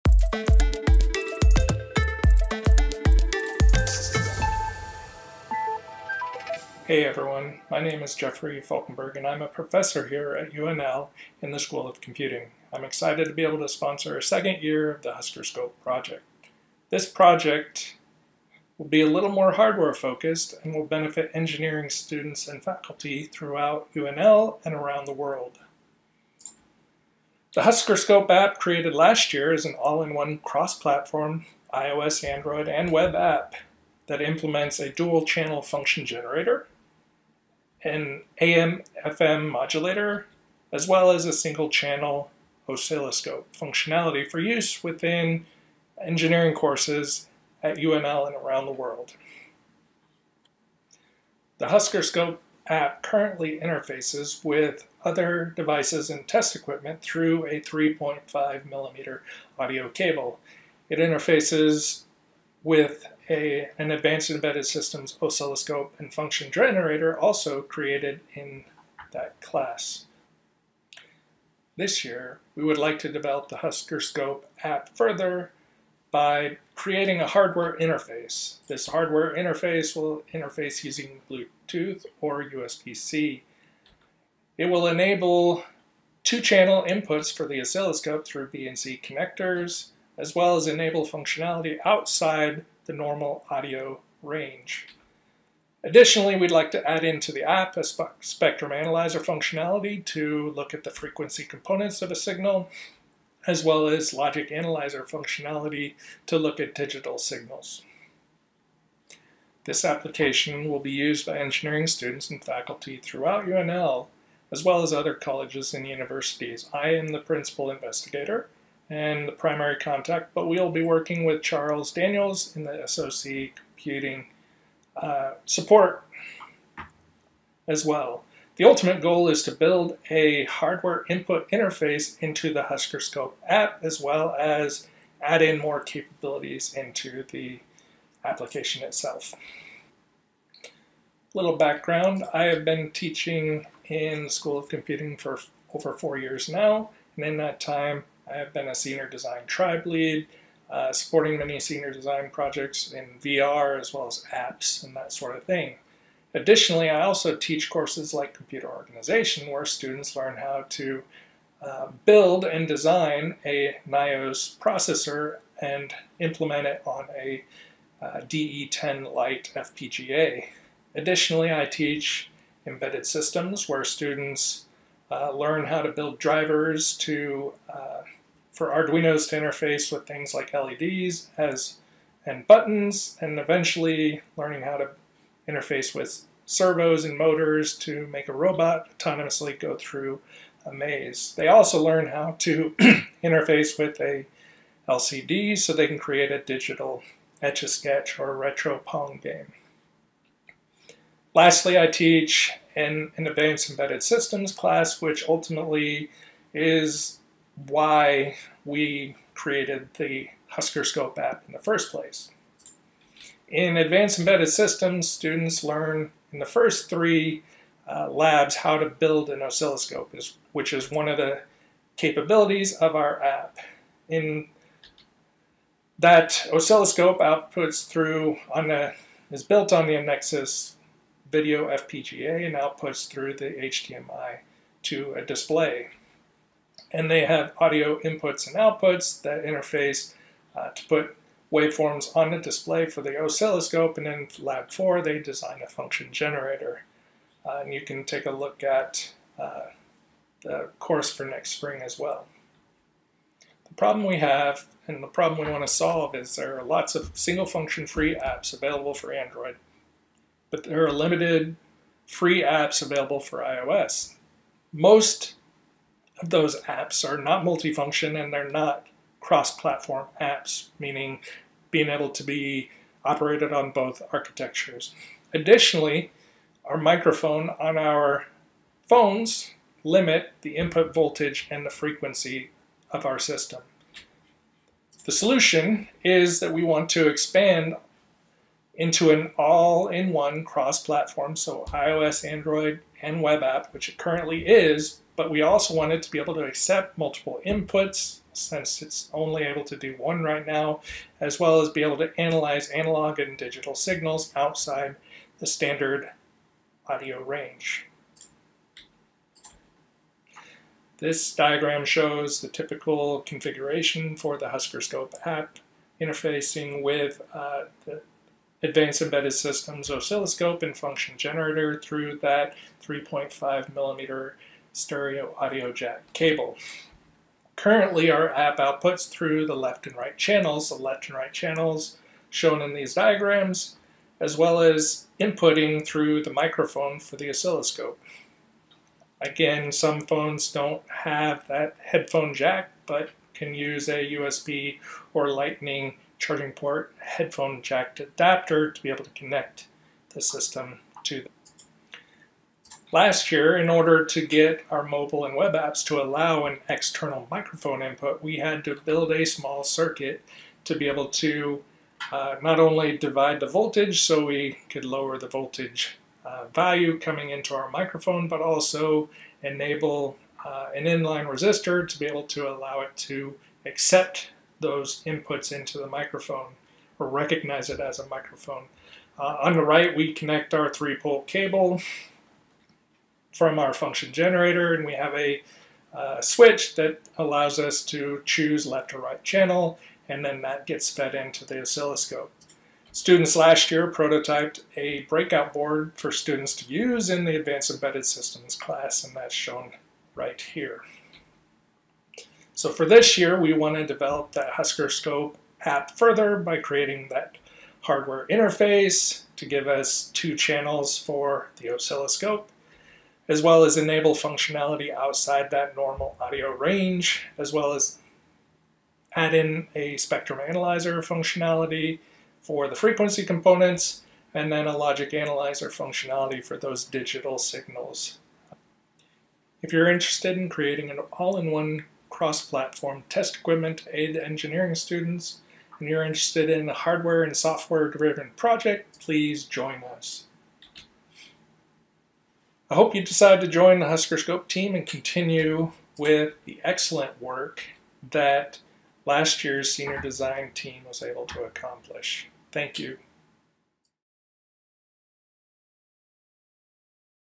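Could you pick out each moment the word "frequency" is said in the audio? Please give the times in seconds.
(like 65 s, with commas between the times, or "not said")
100 s, 281 s, 422 s.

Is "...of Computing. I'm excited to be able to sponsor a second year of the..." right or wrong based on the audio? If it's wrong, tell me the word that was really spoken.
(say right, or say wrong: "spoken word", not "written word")
right.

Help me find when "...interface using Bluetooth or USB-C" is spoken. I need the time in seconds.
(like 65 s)
80 s.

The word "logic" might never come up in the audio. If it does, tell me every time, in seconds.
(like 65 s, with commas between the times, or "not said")
104 s, 424 s.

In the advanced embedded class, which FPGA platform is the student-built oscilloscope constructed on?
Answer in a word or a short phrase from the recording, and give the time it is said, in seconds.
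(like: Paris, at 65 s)
Nexys Video, at 229 s.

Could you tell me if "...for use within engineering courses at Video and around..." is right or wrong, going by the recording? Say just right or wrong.
wrong.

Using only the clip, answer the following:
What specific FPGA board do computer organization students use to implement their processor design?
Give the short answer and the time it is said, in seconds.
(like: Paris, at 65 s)
DE10 Lite, at 168 s.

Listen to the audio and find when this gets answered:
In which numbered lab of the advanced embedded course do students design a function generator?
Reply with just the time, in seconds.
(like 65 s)
244 s.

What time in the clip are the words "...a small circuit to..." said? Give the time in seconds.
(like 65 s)
359 s.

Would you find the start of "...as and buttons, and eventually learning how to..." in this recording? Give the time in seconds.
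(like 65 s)
181 s.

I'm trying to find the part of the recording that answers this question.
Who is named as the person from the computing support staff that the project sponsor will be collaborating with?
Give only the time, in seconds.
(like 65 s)
121 s.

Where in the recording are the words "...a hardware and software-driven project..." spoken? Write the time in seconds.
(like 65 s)
436 s.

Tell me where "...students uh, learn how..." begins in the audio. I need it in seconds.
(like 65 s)
173 s.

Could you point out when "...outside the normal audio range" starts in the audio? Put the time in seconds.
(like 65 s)
91 s.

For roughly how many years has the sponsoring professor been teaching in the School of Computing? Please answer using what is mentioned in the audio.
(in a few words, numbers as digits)
over 4 years.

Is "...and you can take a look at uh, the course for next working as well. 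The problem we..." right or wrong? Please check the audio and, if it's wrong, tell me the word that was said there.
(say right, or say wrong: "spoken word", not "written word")
wrong: "spring", not "working".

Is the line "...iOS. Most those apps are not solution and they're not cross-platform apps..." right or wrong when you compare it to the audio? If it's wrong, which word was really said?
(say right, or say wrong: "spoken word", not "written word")
wrong: "multifunction", not "solution".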